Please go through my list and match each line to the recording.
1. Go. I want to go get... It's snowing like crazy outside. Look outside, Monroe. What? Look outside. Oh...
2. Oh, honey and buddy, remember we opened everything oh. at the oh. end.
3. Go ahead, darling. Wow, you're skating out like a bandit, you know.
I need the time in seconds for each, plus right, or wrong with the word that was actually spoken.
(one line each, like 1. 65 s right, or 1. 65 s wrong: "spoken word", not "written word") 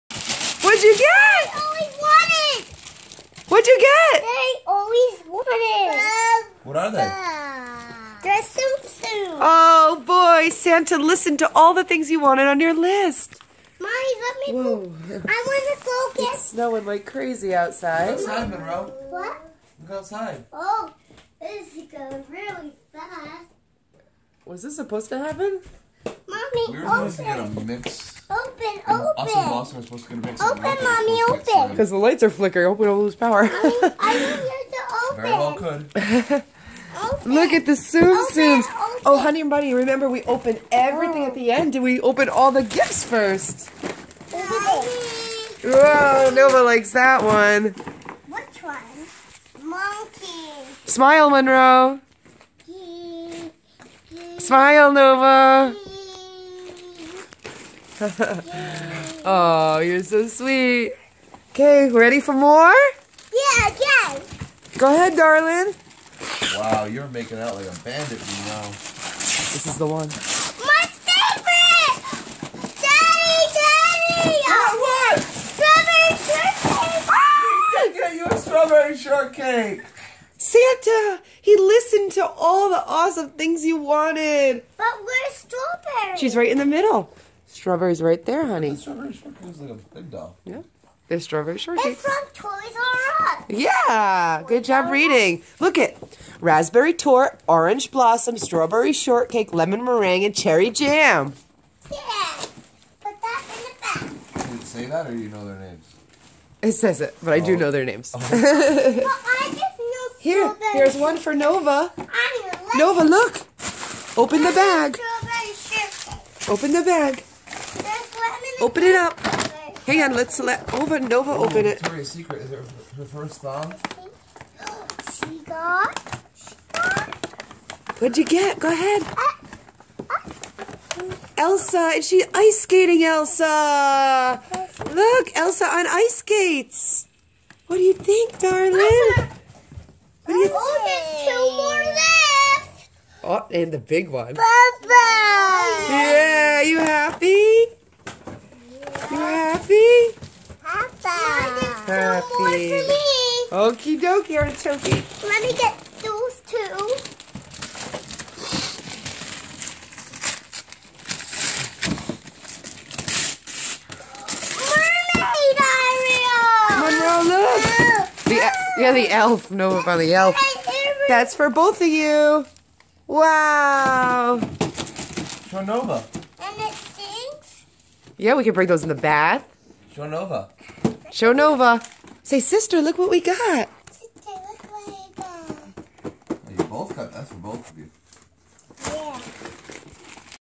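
1. 14 s right
2. 39 s right
3. 64 s wrong: "making", not "skating".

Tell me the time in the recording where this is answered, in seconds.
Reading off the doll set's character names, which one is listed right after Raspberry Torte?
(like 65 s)
97 s.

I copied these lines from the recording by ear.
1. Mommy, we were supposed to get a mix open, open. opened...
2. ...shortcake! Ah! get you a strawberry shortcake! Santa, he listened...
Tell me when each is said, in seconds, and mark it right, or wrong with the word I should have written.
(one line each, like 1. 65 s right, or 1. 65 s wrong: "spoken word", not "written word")
1. 26 s wrong: "supposed", not "opened"
2. 76 s right.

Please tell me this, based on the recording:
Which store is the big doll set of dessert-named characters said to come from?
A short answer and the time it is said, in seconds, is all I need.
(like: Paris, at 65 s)
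Toys R Us, at 92 s.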